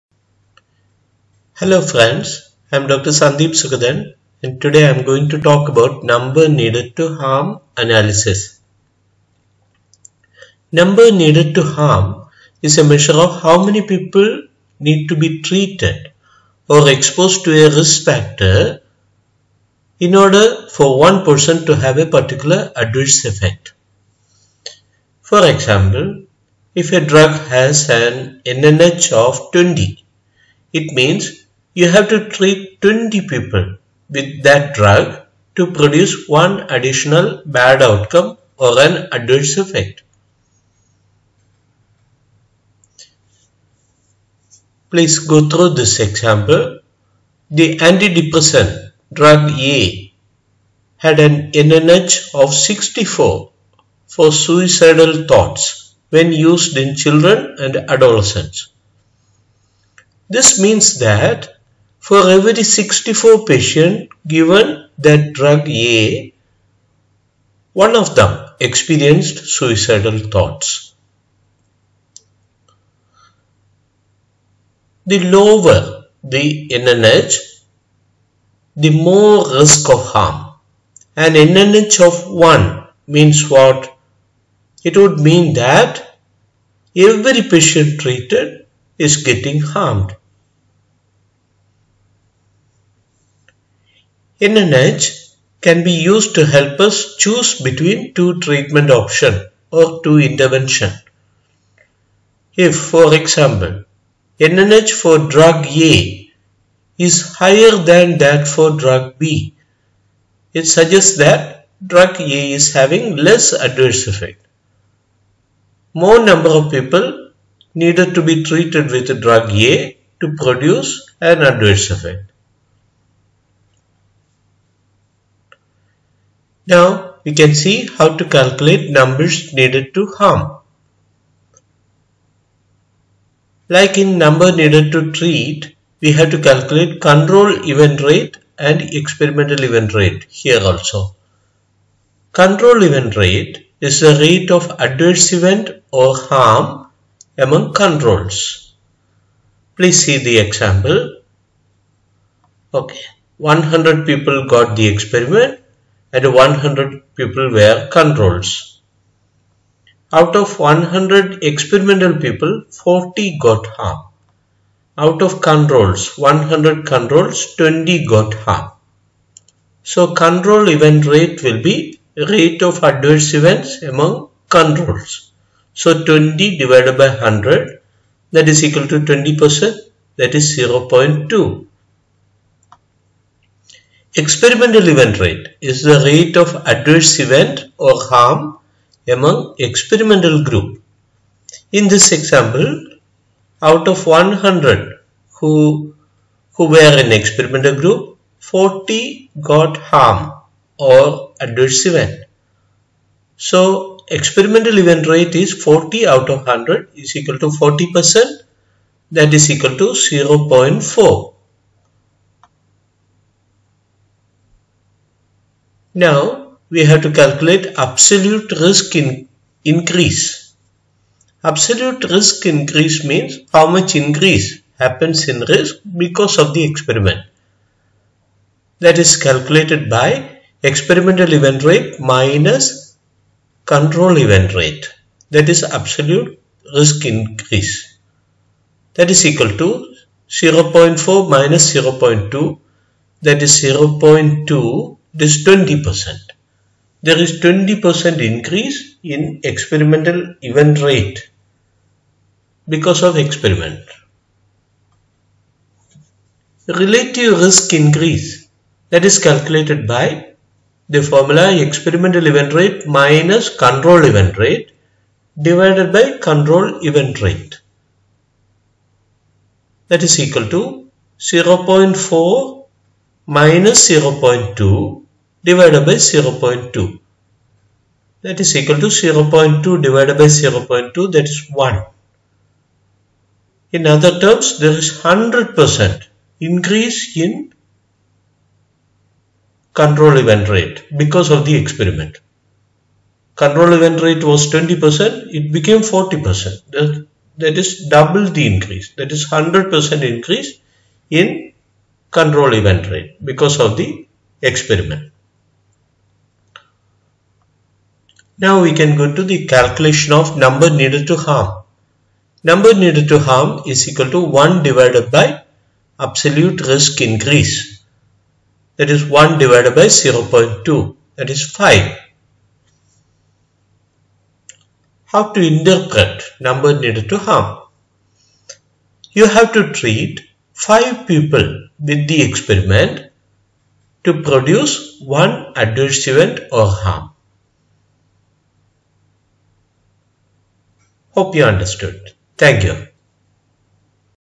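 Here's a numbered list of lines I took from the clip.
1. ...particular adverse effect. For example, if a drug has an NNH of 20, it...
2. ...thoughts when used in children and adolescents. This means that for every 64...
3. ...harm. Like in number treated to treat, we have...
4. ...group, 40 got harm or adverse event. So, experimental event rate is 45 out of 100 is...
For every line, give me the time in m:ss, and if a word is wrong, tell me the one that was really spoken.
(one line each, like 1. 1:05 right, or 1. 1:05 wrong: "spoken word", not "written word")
1. 0:22 right
2. 0:55 right
3. 2:10 wrong: "needed", not "treated"
4. 3:17 wrong: "40", not "45".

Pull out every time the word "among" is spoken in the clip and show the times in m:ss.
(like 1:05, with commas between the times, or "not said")
2:27, 2:53, 3:09.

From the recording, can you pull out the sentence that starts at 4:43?
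In other terms there is 100% increase in control event rate because of the experiment.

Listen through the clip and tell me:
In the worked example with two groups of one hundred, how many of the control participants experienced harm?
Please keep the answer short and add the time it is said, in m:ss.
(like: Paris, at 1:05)
20, at 2:47.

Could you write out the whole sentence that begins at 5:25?
How to interpret number needed to harm?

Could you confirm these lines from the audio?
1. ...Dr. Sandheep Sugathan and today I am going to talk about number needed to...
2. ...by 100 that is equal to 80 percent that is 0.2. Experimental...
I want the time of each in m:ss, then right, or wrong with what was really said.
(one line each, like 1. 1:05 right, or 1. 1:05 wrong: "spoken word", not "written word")
1. 0:02 right
2. 2:56 wrong: "20", not "80".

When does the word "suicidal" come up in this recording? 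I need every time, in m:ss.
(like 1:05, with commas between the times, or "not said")
0:54, 1:09.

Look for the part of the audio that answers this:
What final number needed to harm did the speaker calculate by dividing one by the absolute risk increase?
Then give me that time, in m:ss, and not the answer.
5:21.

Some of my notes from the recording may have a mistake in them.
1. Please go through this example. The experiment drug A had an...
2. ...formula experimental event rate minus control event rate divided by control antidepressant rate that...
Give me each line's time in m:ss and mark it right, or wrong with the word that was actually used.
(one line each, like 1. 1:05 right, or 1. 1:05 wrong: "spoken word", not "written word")
1. 0:44 wrong: "antidepressant", not "experiment"
2. 4:21 wrong: "event", not "antidepressant".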